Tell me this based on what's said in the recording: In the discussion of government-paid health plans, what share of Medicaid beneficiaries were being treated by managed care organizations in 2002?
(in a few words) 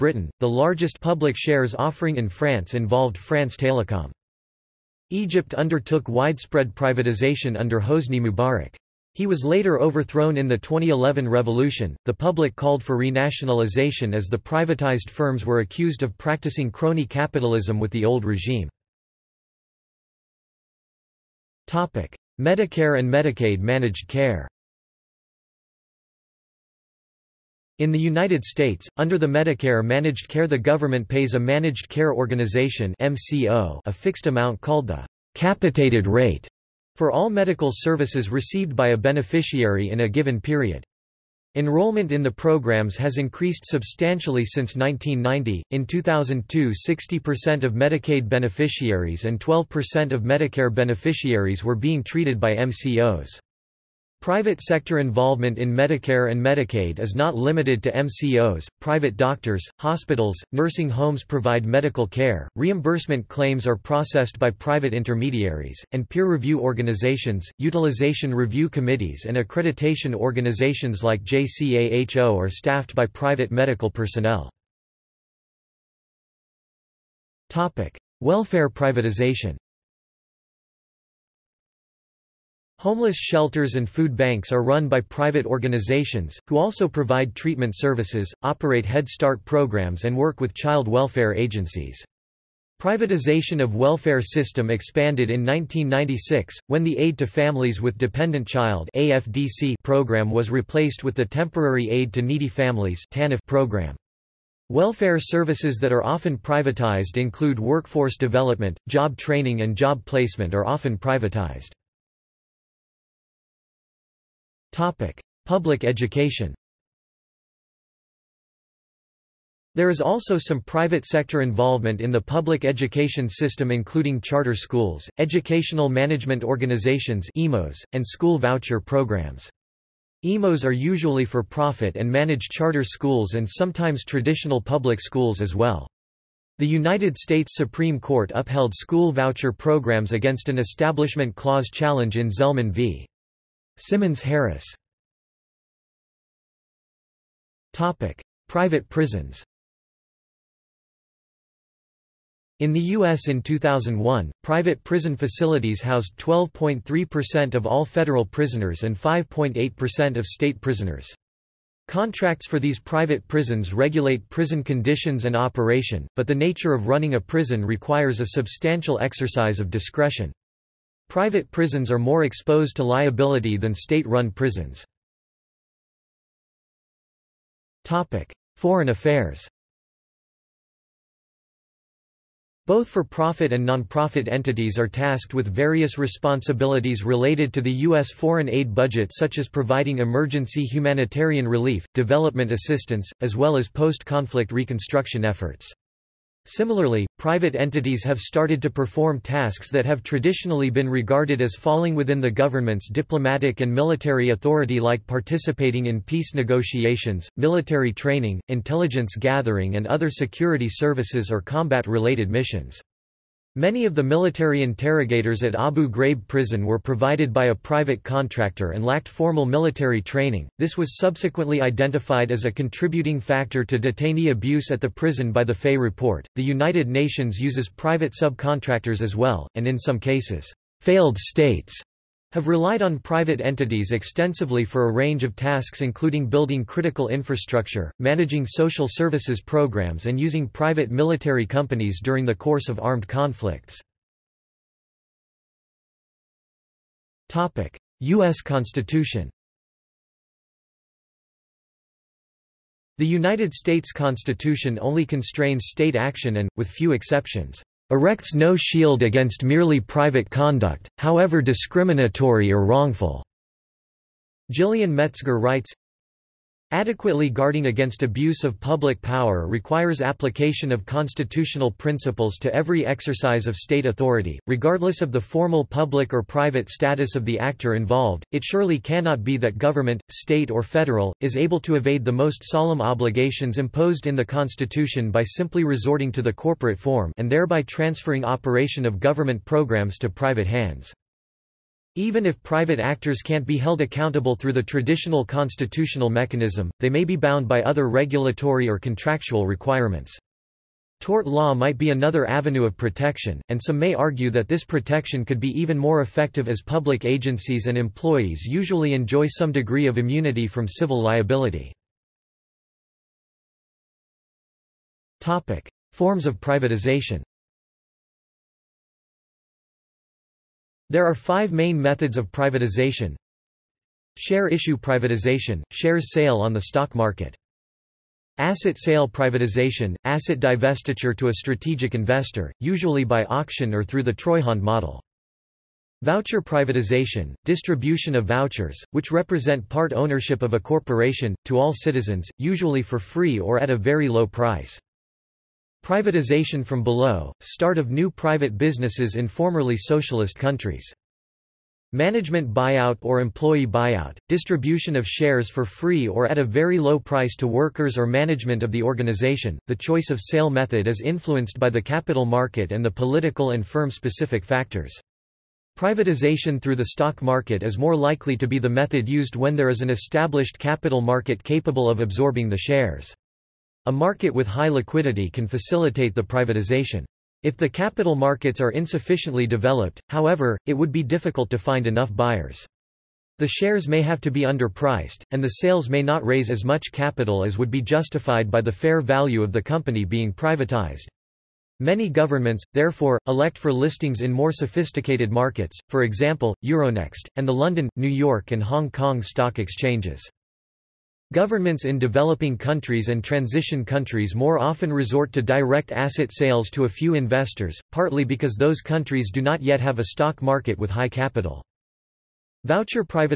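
60%.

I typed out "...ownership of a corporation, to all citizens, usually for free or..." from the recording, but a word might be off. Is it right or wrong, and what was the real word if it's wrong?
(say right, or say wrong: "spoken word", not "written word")
right.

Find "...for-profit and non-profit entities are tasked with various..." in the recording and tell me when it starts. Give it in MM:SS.
03:02.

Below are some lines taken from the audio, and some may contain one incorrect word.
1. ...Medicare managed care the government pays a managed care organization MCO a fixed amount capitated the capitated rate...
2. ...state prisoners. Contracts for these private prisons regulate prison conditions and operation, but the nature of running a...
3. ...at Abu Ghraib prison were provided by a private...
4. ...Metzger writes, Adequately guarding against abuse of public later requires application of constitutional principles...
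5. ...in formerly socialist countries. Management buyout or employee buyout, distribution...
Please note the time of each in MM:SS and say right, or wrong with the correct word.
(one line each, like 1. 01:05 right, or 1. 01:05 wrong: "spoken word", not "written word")
1. 00:29 wrong: "called", not "capitated"
2. 02:40 right
3. 03:35 right
4. 04:24 wrong: "power", not "later"
5. 05:49 right.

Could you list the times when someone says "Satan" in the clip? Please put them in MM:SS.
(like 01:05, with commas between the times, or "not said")
not said.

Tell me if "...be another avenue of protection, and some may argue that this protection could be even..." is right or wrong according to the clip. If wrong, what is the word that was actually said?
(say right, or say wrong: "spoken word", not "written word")
right.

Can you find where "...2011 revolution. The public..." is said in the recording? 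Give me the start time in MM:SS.
00:10.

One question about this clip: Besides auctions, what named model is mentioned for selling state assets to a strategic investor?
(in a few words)
Treuhand model.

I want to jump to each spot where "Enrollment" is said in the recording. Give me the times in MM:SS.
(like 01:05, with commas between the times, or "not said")
00:41.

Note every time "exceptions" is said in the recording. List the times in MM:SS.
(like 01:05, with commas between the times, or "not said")
04:16.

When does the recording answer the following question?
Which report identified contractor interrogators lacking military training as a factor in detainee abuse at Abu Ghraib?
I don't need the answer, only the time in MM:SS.
03:45.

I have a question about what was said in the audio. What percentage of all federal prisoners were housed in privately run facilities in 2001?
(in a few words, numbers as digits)
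12.3%.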